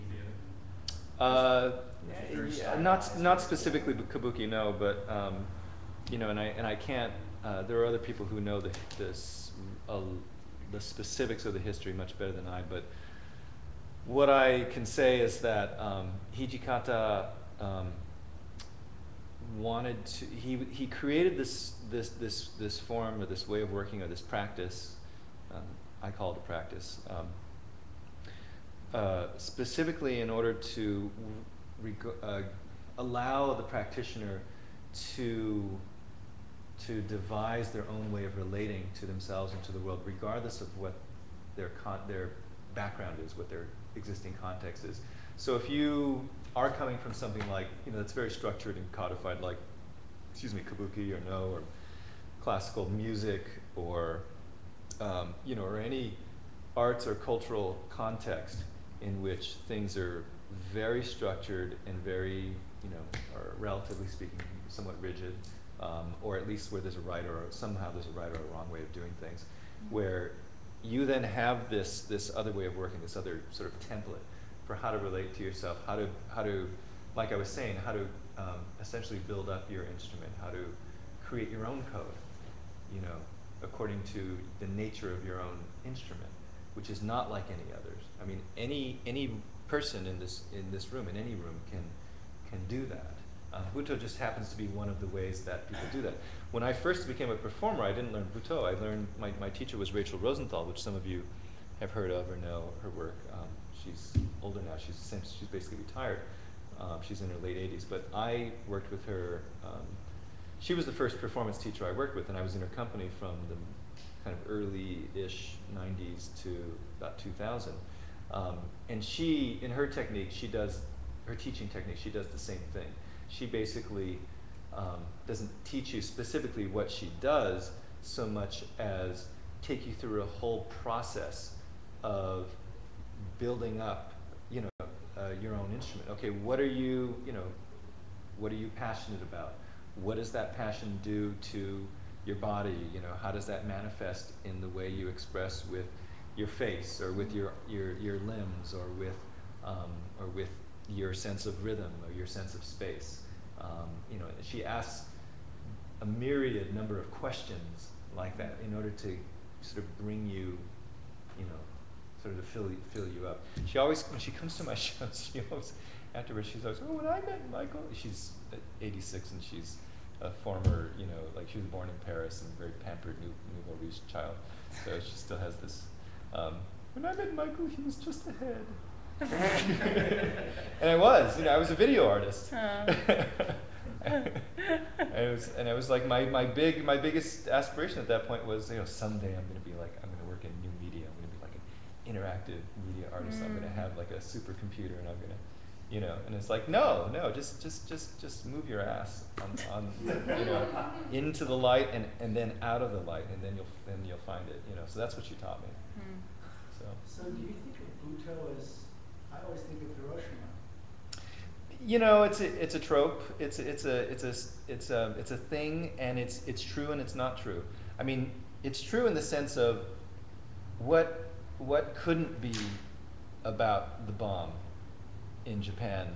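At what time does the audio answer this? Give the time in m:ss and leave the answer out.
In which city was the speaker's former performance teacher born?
2:52.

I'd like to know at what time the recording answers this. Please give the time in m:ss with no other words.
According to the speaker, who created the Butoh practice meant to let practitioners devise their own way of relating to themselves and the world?
0:16.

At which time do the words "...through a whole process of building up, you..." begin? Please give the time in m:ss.
2:09.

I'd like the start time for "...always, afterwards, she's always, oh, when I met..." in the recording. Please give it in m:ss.
2:45.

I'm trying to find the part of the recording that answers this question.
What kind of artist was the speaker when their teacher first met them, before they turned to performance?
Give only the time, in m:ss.
3:01.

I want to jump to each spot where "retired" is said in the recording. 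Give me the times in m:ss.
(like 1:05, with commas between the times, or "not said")
1:45.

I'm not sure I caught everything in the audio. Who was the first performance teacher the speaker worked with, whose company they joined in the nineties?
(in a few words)
Rachel Rosenthal.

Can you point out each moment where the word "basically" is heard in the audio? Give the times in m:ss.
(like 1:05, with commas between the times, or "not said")
1:45, 2:03.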